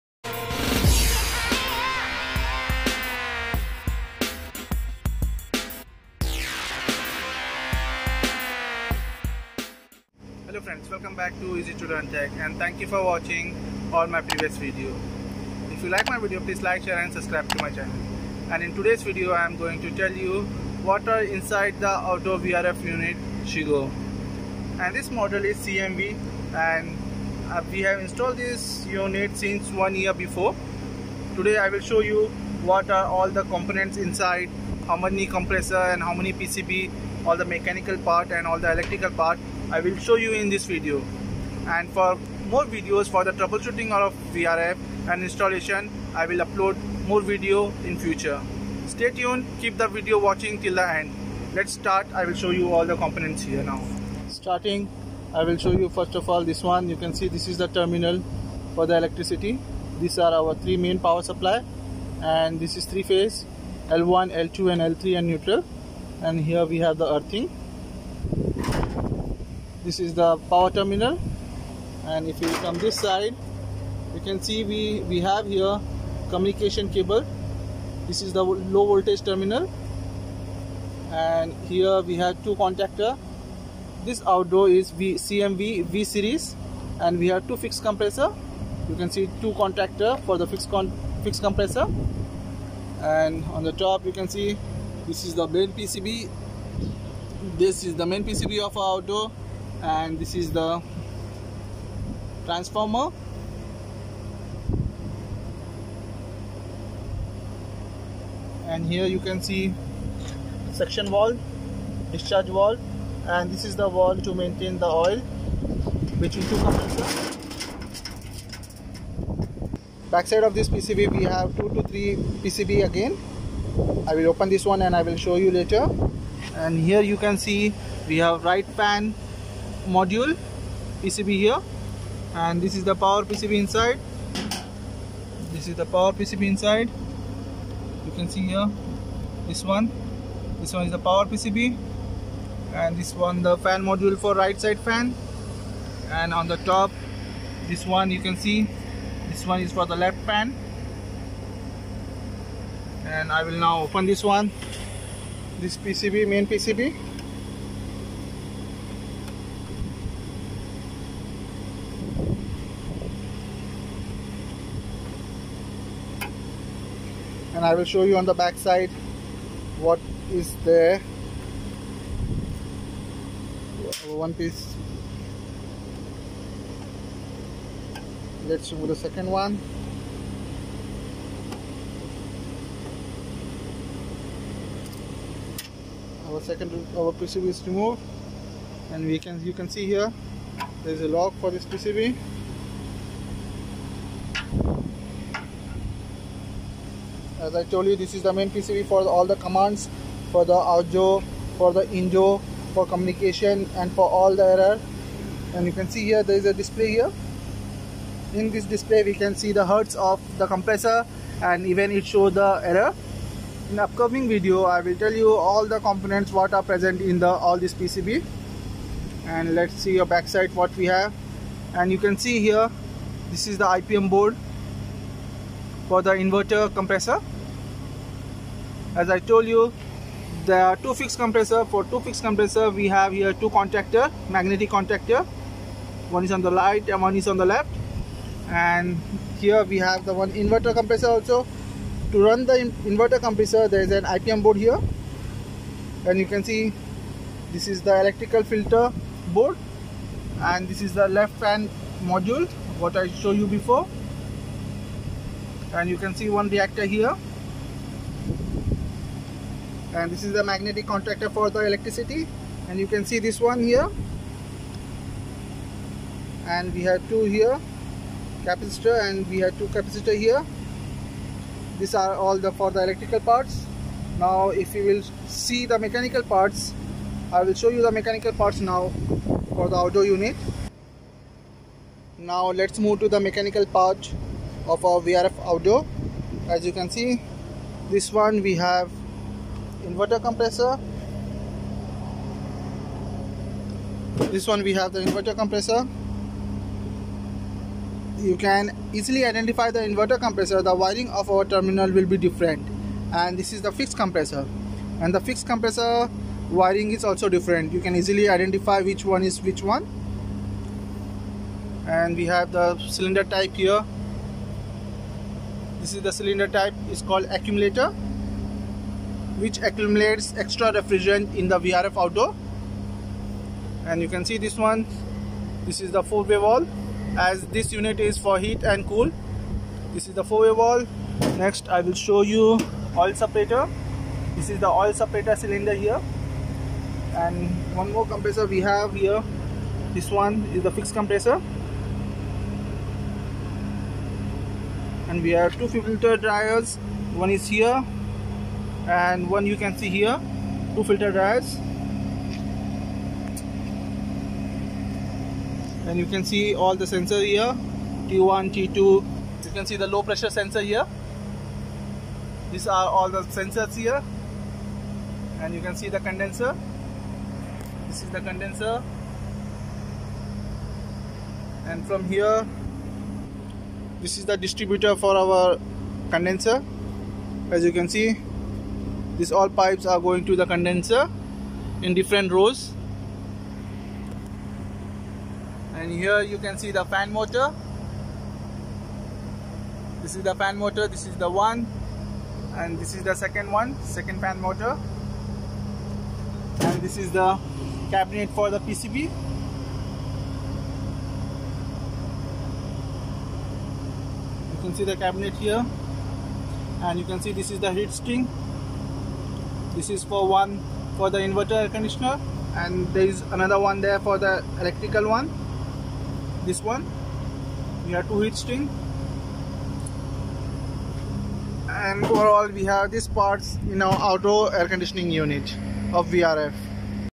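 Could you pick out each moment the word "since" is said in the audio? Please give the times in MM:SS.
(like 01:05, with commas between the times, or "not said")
00:29.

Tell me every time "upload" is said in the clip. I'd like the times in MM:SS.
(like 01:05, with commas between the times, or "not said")
00:46.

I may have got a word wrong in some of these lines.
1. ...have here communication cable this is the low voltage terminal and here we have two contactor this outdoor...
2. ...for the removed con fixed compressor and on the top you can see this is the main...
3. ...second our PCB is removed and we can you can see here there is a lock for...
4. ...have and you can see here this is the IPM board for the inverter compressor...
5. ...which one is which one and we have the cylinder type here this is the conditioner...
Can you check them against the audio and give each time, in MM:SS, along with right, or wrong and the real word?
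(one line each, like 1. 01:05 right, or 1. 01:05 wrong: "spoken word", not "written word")
1. 01:15 right
2. 01:30 wrong: "fixed", not "removed"
3. 03:06 right
4. 03:40 right
5. 05:08 wrong: "cylinder", not "conditioner".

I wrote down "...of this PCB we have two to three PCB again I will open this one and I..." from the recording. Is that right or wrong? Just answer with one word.
right.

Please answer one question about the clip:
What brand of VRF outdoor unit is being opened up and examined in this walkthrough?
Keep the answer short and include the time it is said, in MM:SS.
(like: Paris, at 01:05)
Chigo, at 00:23.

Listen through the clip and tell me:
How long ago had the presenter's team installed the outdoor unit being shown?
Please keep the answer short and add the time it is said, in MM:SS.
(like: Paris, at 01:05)
One year, at 00:29.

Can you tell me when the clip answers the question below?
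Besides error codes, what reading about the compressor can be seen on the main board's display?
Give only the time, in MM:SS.
03:29.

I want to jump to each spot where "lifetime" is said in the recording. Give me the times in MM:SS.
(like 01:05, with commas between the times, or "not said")
not said.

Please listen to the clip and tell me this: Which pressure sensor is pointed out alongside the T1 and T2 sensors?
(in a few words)
Low pressure sensor.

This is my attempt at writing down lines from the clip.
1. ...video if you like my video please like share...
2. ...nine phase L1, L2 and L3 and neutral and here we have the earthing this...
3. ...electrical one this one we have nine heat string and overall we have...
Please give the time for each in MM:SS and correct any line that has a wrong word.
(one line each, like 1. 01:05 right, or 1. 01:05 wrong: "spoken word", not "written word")
1. 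00:14 right
2. 01:02 wrong: "three", not "nine"
3. 06:54 wrong: "two", not "nine".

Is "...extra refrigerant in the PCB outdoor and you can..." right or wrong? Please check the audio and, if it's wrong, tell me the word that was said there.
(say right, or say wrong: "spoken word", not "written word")
wrong: "VRF", not "PCB".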